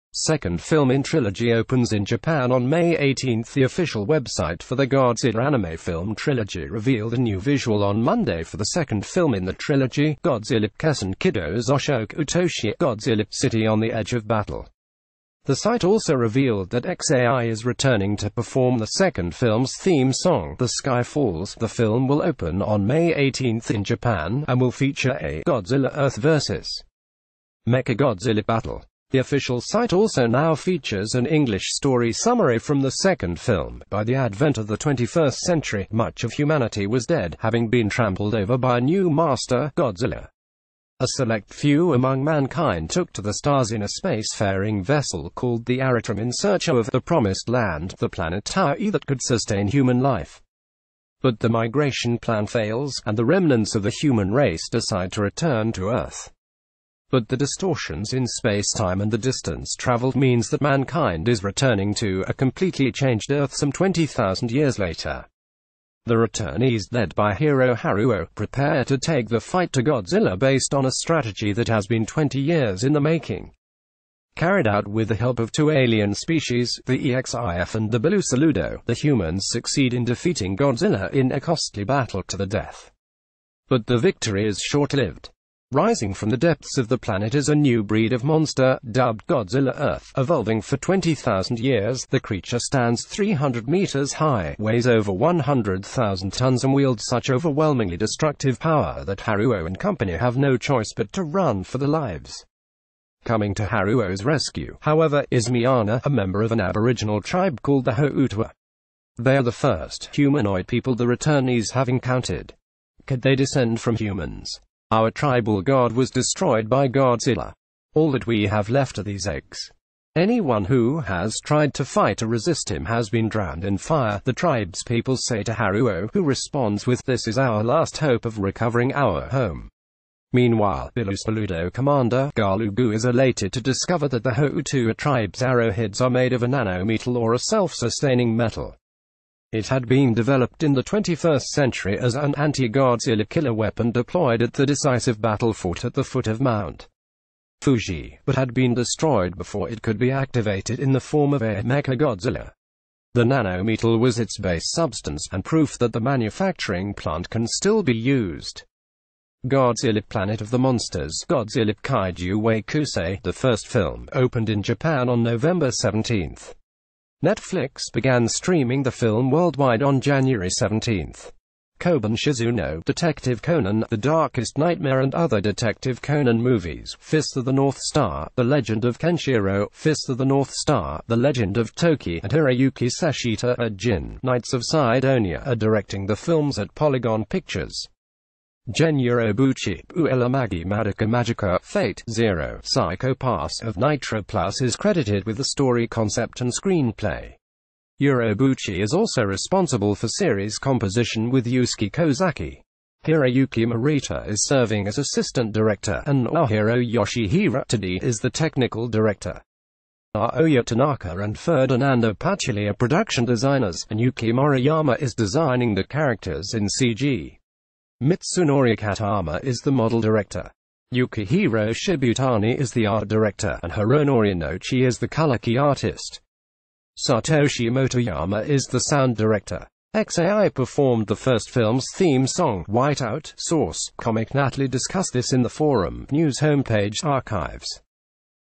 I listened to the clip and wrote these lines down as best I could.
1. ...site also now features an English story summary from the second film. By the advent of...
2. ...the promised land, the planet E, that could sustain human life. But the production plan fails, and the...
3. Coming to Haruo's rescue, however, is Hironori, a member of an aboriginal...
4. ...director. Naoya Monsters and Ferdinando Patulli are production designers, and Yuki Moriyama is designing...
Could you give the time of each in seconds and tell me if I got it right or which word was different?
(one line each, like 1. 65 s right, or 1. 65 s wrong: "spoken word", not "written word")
1. 29 s right
2. 46 s wrong: "migration", not "production"
3. 103 s wrong: "Miana", not "Hironori"
4. 208 s wrong: "Tanaka", not "Monsters".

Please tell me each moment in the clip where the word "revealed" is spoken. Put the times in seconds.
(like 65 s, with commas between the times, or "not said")
6 s, 16 s.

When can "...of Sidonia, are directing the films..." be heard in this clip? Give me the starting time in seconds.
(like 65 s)
184 s.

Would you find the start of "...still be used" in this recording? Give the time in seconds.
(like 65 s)
157 s.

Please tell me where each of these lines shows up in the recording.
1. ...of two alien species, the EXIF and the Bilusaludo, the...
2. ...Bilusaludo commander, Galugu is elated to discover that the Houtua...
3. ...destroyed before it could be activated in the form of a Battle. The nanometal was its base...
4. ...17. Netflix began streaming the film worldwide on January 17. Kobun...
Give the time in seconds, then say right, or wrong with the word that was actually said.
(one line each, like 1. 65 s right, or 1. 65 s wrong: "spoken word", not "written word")
1. 75 s right
2. 130 s right
3. 148 s wrong: "Mechagodzilla", not "Battle"
4. 165 s right.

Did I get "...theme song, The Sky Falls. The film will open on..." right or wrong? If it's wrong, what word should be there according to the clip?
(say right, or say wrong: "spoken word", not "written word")
right.